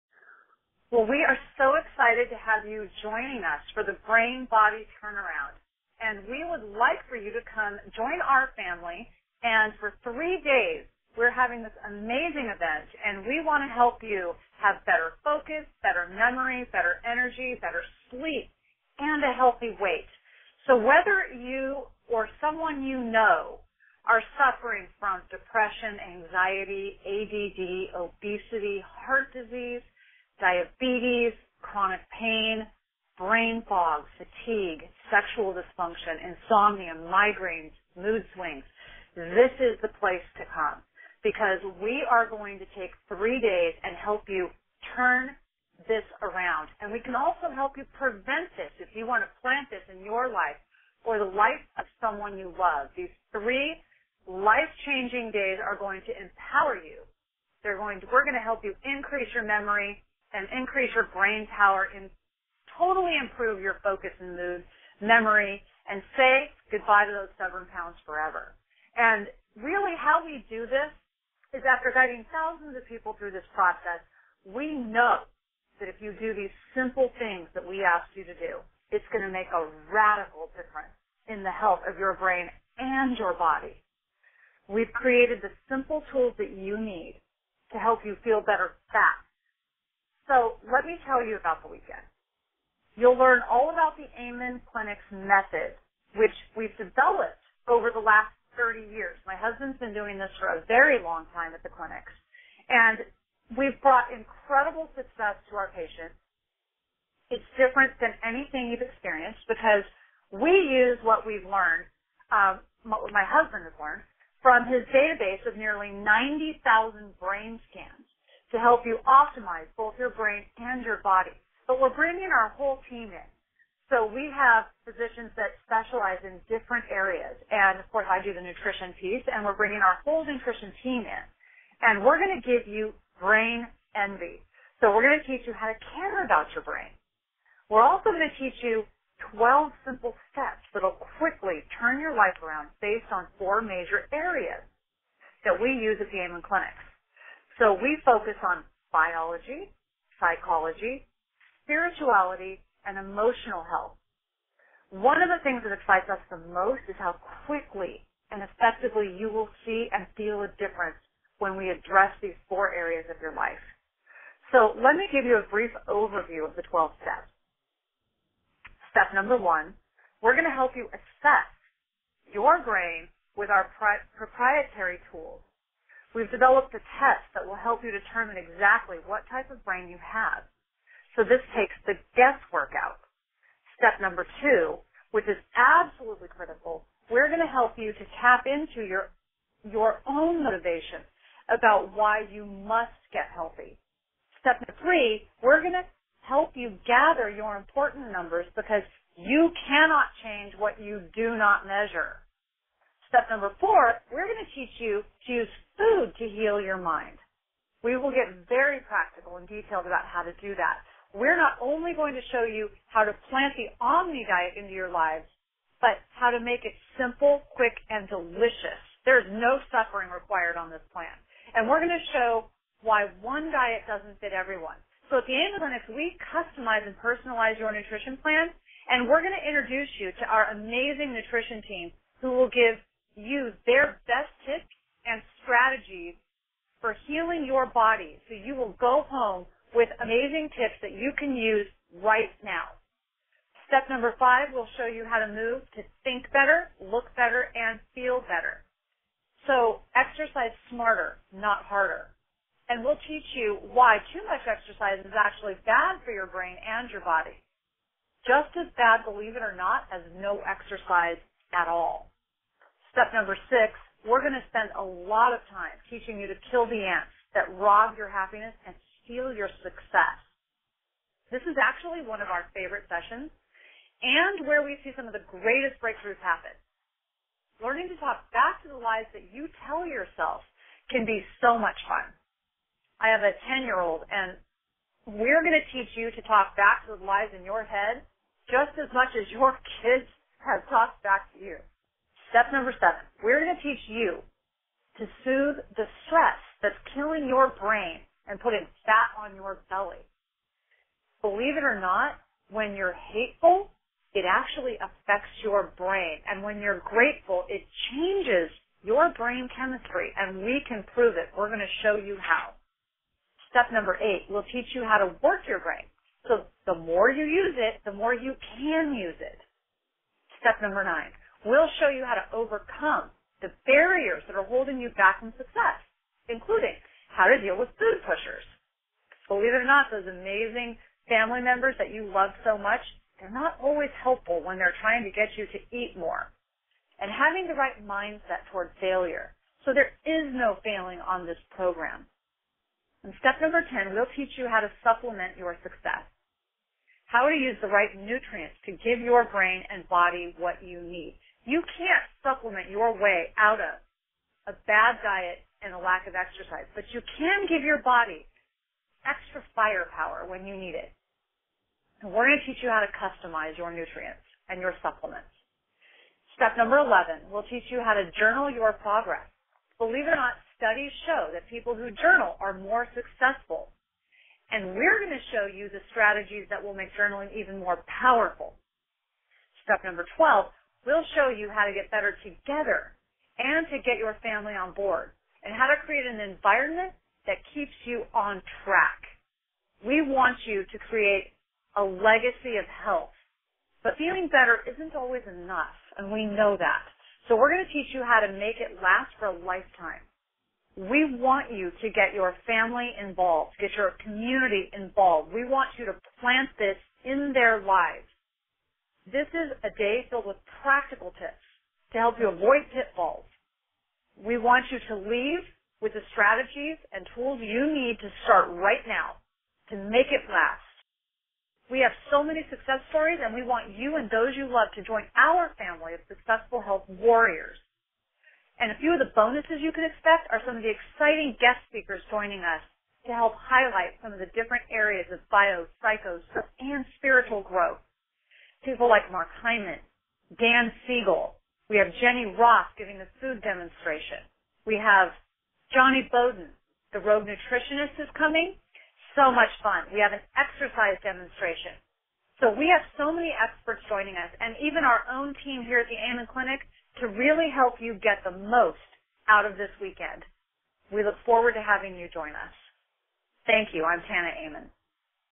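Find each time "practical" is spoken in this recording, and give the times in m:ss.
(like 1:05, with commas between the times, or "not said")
3:28, 6:50.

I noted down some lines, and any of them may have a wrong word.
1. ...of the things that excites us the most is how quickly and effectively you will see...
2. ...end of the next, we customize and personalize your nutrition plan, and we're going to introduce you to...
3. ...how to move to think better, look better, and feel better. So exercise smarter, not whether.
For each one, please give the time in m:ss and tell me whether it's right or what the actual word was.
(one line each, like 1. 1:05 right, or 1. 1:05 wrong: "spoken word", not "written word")
1. 2:35 right
2. 3:45 right
3. 4:05 wrong: "harder", not "whether".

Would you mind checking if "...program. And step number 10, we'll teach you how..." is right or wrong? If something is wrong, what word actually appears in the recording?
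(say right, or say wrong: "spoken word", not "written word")
right.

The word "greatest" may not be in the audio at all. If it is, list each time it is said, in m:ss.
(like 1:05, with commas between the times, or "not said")
4:35.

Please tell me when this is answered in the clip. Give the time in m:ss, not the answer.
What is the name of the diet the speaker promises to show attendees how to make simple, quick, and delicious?
3:33.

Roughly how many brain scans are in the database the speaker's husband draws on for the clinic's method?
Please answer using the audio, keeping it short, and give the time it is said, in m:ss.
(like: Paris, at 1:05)
90,000, at 1:55.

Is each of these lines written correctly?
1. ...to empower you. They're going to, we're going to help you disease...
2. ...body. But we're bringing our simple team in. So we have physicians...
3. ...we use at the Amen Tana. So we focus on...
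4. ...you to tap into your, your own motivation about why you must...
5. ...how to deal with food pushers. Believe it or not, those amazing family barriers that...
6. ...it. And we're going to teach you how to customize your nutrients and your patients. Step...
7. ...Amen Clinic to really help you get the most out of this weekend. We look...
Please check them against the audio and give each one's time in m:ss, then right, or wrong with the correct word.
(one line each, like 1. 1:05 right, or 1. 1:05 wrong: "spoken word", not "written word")
1. 0:56 wrong: "increase", not "disease"
2. 2:01 wrong: "whole", not "simple"
3. 2:25 wrong: "Clinics", not "Tana"
4. 3:07 right
5. 5:27 wrong: "members", not "barriers"
6. 6:00 wrong: "supplements", not "patients"
7. 7:35 right.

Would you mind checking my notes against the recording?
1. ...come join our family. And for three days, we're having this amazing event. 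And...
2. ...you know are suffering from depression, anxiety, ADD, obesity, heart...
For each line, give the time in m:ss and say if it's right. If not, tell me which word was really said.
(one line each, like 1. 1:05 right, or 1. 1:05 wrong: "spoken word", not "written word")
1. 0:07 right
2. 0:22 right.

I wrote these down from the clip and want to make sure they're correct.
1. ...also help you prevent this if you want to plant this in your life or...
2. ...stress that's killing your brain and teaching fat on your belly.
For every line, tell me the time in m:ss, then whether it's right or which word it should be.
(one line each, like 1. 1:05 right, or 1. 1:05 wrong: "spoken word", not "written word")
1. 0:47 right
2. 4:56 wrong: "putting", not "teaching".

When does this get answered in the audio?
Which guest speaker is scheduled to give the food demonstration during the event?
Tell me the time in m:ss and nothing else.
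7:22.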